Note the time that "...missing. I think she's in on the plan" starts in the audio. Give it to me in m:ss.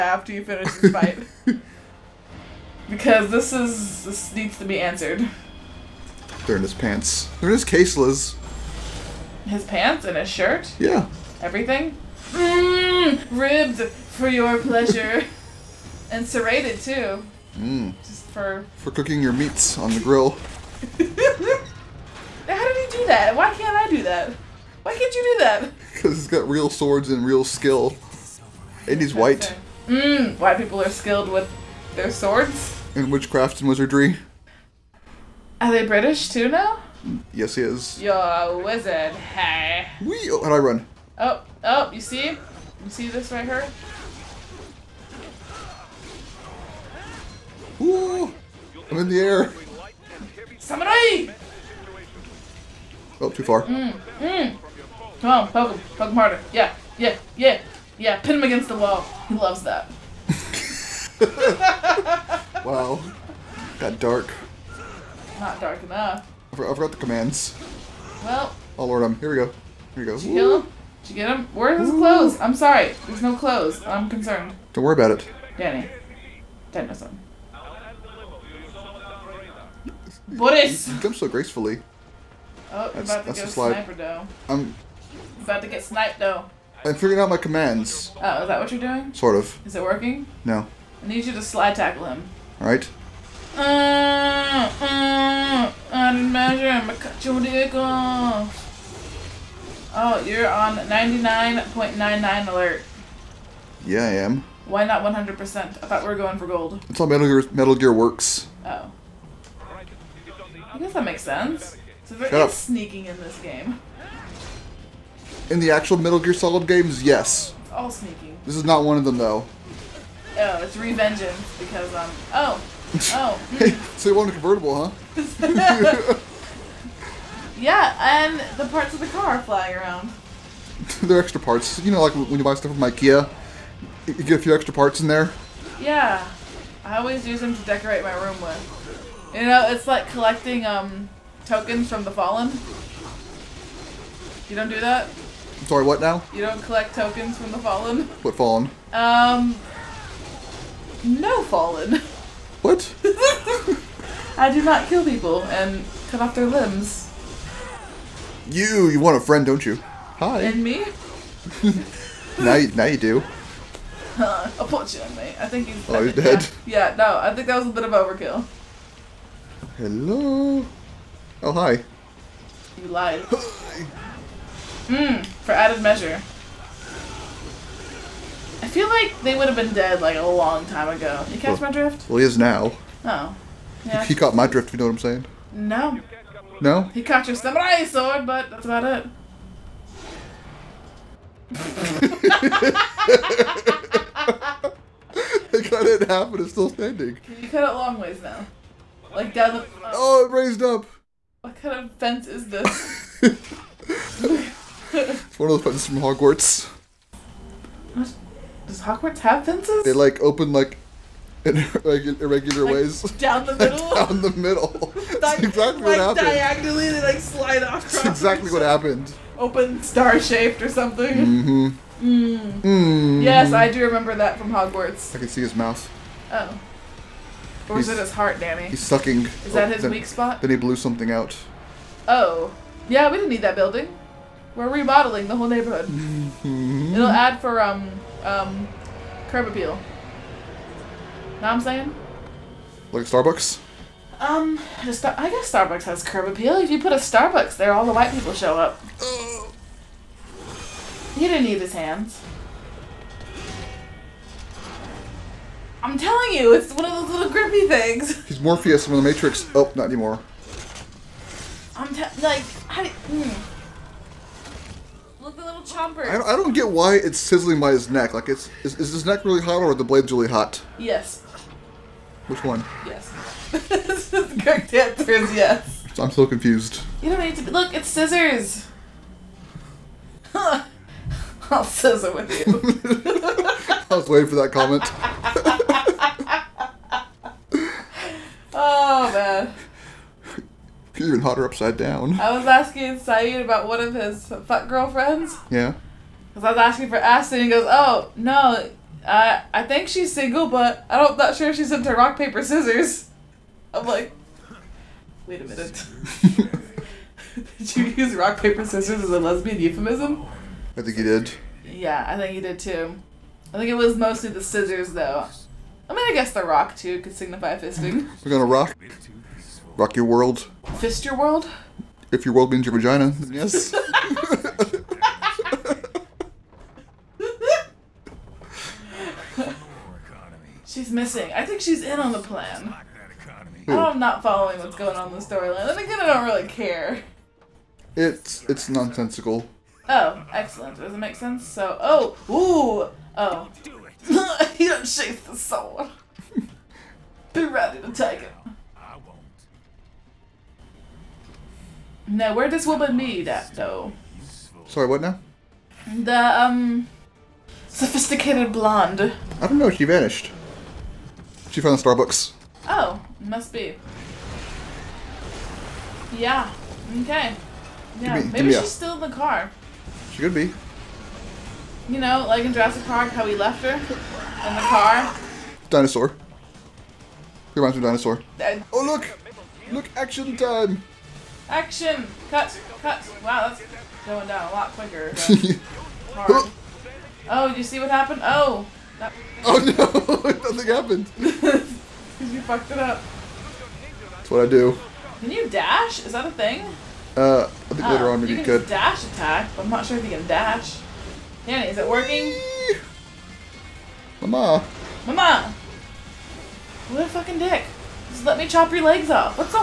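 5:30.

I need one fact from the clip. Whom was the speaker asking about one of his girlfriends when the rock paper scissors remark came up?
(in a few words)
Saeed.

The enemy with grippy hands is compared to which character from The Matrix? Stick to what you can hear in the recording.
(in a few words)
Morpheus.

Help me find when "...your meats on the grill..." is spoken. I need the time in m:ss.
0:19.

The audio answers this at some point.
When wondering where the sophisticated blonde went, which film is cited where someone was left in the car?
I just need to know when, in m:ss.
6:12.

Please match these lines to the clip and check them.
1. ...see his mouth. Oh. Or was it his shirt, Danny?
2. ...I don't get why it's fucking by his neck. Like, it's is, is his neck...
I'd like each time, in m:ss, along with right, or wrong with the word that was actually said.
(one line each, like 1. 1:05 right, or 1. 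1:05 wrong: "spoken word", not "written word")
1. 3:45 wrong: "heart", not "shirt"
2. 4:26 wrong: "sizzling", not "fucking".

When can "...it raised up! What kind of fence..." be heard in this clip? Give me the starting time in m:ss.
3:20.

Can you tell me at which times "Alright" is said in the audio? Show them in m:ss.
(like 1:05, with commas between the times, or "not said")
1:32.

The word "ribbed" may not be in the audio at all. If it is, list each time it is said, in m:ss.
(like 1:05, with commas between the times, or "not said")
0:13.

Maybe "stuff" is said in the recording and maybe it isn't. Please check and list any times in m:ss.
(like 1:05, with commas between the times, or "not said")
2:12.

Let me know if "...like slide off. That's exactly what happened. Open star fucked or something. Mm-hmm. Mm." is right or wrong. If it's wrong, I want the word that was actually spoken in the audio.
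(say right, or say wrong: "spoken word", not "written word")
wrong: "shaped", not "fucked".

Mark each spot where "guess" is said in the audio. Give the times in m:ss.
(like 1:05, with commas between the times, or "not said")
1:50, 4:04, 5:16.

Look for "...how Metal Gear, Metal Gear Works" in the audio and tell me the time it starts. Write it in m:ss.
1:46.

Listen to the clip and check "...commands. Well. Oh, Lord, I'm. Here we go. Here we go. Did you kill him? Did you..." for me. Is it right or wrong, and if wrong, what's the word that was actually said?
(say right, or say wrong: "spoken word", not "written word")
right.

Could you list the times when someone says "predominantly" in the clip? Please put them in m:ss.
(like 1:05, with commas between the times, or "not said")
not said.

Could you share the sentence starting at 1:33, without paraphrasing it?
Uh, uh, I uh, didn't measure him.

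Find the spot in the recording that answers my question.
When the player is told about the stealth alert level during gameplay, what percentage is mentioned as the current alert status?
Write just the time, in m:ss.
1:40.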